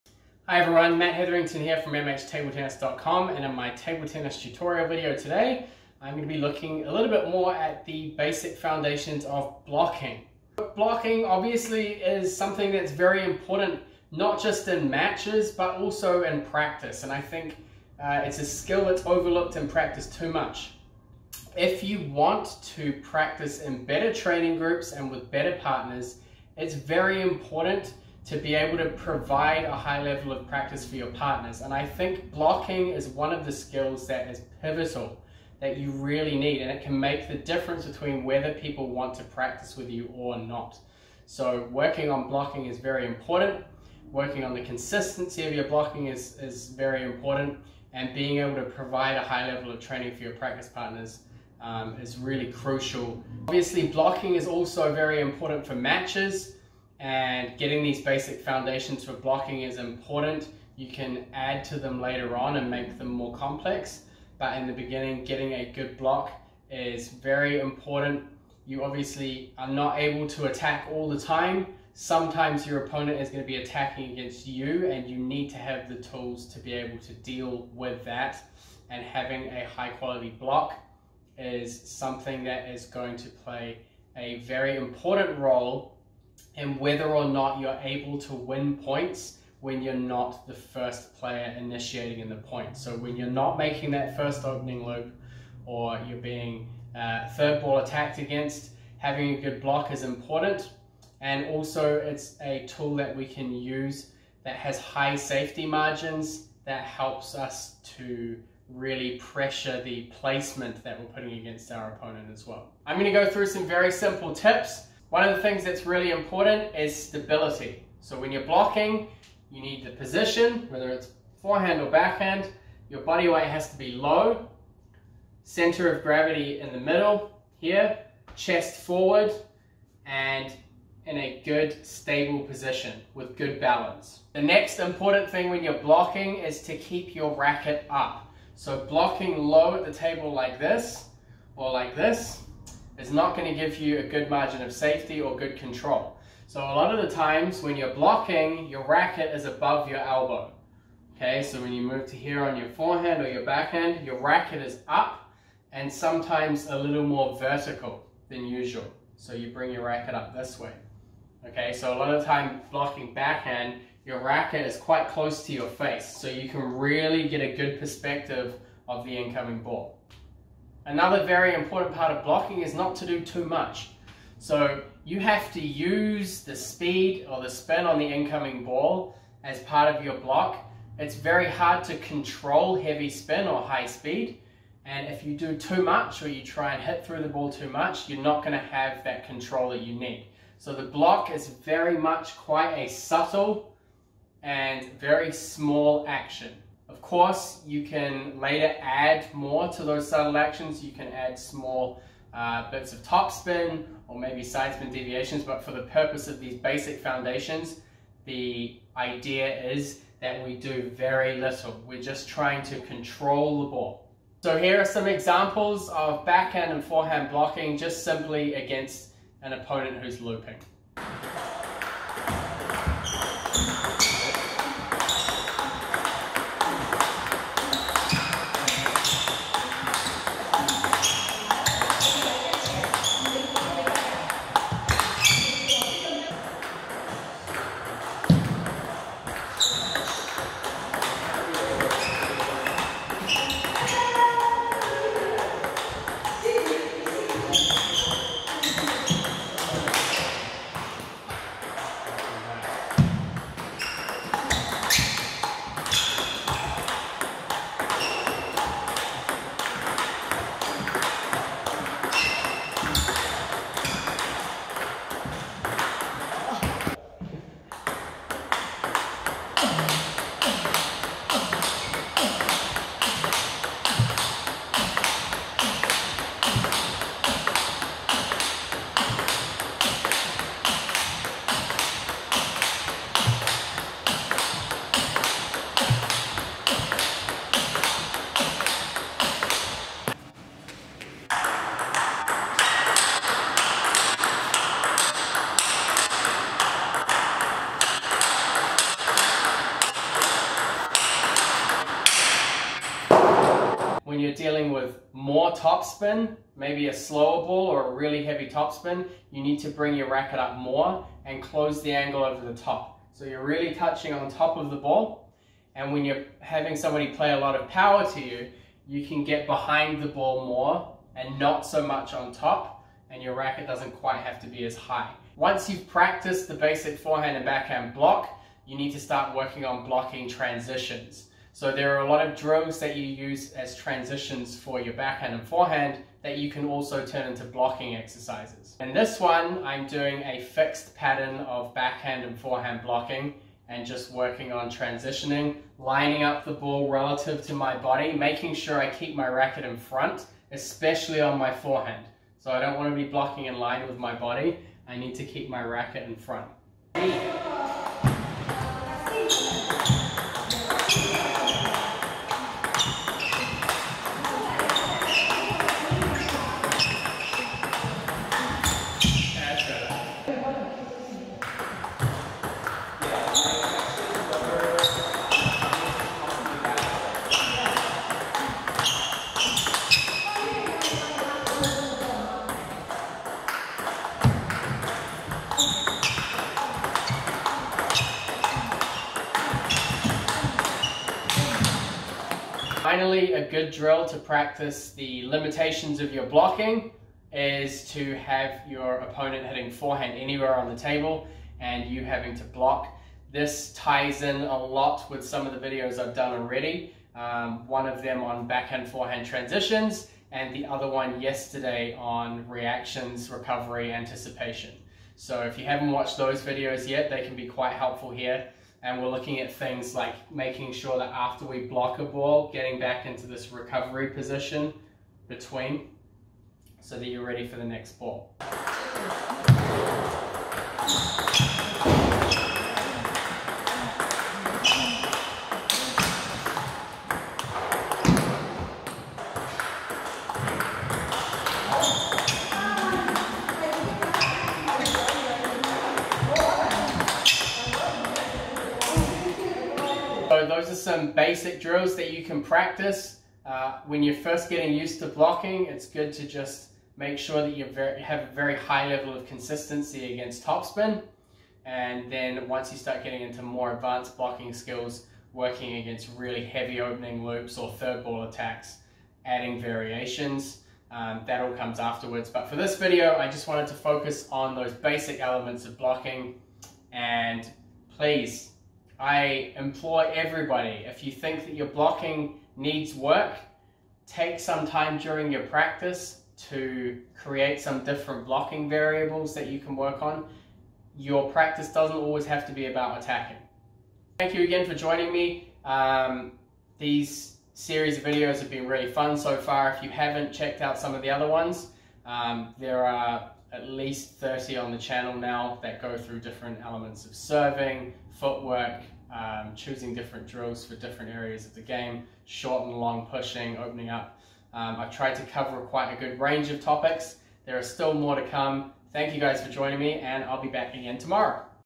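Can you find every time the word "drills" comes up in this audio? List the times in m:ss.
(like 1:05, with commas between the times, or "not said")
5:32, 6:33, 7:31, 8:30.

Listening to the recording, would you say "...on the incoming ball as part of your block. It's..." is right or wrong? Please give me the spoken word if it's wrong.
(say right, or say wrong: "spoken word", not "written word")
right.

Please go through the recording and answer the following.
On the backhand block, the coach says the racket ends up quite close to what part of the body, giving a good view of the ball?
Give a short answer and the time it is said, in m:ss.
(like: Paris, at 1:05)
Face, at 2:45.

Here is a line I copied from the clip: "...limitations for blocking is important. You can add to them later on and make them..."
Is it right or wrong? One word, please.
wrong.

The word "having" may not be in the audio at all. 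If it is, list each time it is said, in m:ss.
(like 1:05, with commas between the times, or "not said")
1:19, 1:38, 5:16, 6:42.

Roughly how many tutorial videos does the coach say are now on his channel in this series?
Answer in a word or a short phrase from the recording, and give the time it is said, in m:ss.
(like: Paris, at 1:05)
At least 30, at 8:23.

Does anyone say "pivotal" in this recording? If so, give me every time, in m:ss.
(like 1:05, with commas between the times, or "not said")
0:34.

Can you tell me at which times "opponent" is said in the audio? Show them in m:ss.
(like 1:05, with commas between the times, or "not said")
1:12, 1:51, 3:39, 6:39.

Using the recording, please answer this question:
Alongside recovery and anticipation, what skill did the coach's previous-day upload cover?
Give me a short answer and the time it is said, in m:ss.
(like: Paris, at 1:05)
Reactions, at 6:52.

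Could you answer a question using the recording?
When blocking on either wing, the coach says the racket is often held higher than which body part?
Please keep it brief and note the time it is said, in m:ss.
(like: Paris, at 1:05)
Elbow, at 2:29.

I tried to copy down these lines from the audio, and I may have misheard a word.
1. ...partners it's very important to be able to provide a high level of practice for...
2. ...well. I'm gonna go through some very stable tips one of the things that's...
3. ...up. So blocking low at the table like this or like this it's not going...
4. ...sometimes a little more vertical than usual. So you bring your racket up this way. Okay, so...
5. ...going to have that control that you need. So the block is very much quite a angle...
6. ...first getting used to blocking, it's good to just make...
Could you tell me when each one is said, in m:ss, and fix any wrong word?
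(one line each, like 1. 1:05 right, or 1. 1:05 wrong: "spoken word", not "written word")
1. 0:25 right
2. 1:52 wrong: "simple", not "stable"
3. 2:17 right
4. 2:35 right
5. 3:08 wrong: "subtle", not "angle"
6. 7:34 right.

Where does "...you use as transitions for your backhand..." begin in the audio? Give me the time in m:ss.
5:32.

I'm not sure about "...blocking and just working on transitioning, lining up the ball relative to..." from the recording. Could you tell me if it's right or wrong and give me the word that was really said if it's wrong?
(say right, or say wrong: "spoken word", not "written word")
right.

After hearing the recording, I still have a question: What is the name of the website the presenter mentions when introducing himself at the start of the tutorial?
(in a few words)
MHTableTennis.com.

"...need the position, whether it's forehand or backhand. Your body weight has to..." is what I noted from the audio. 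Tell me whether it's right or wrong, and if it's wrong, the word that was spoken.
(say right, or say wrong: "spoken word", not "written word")
right.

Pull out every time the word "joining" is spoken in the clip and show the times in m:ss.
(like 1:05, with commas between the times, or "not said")
8:14, 8:39.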